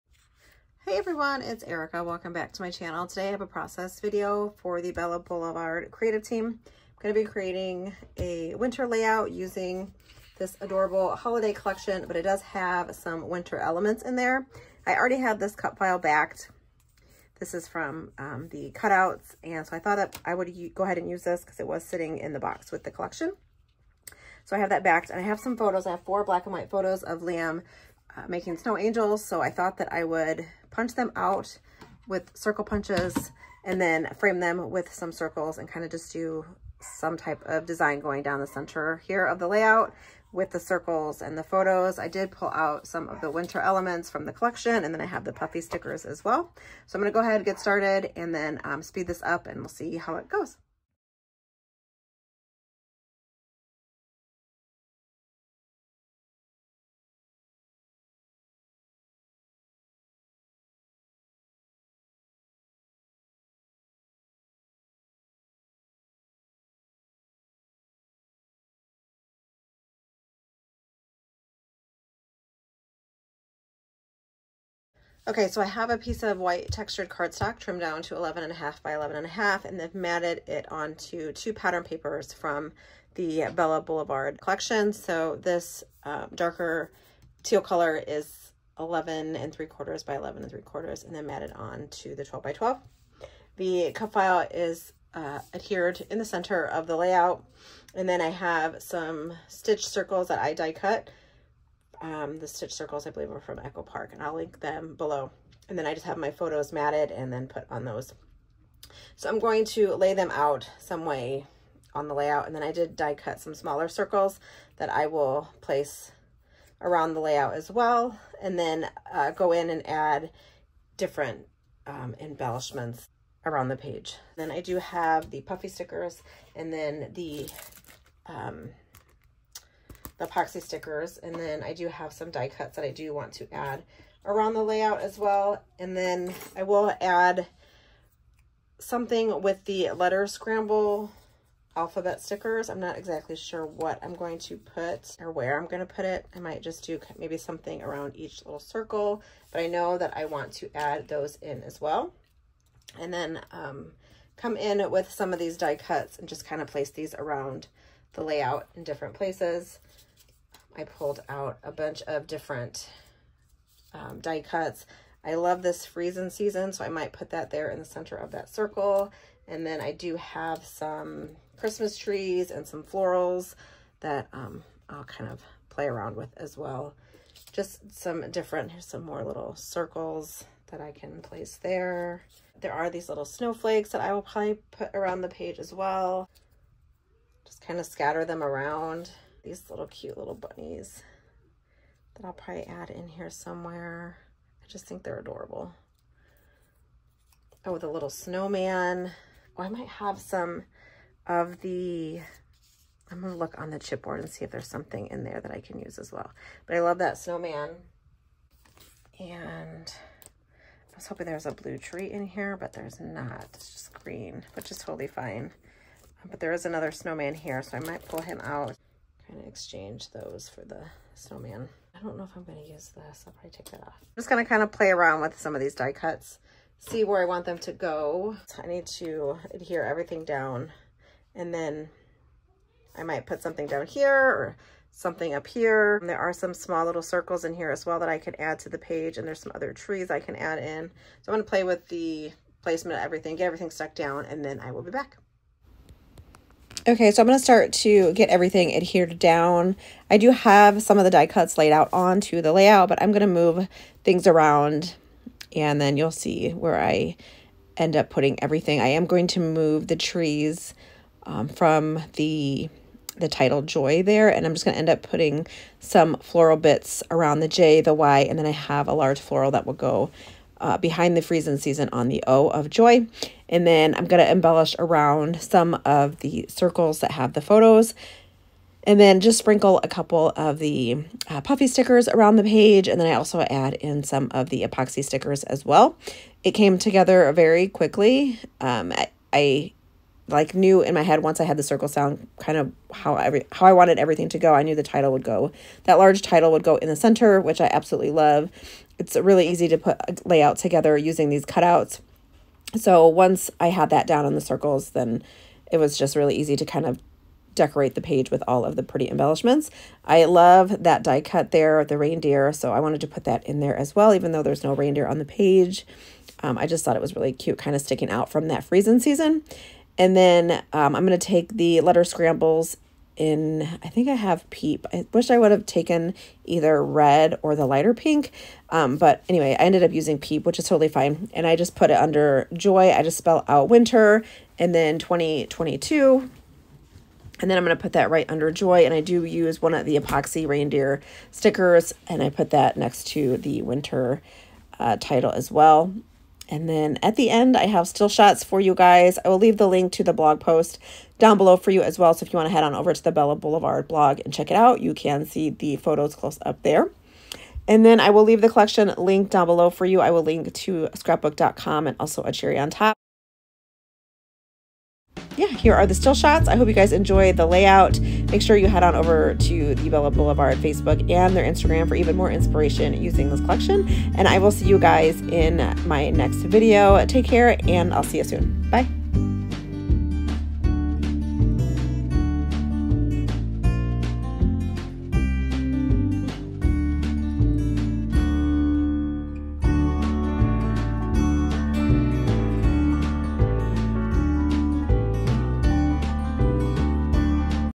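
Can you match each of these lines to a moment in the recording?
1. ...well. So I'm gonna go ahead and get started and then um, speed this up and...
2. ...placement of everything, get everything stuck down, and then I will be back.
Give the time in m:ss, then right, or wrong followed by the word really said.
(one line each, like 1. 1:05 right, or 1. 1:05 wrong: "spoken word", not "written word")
1. 0:46 right
2. 4:02 right.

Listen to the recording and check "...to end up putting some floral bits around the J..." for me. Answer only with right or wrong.
right.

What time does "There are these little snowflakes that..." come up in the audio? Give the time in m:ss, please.
3:02.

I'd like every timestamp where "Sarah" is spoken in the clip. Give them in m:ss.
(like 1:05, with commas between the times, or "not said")
not said.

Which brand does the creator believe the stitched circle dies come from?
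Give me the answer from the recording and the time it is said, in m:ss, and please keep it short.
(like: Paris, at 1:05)
Echo Park, at 1:43.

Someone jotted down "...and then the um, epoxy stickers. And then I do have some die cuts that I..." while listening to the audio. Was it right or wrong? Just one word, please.
right.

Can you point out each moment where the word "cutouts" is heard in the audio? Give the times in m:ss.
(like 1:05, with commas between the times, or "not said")
0:18, 5:01.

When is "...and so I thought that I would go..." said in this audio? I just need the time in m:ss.
0:19.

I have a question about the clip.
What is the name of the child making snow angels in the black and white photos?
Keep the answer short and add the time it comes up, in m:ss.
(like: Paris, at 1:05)
Liam, at 0:27.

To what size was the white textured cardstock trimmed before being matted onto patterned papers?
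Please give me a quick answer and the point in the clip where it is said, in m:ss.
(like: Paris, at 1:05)
11 and a half by 11 and a half, at 1:18.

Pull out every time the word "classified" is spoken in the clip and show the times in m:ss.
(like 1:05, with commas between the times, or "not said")
not said.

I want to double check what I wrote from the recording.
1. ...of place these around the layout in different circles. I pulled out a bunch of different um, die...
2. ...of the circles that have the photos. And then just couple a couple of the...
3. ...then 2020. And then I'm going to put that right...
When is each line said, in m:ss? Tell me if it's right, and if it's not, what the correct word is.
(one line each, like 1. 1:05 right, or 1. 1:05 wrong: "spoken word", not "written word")
1. 2:36 wrong: "places", not "circles"
2. 4:35 wrong: "sprinkle", not "couple"
3. 5:34 wrong: "2022", not "2020".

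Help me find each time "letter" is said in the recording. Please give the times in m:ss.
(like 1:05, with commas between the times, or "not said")
2:19, 5:21.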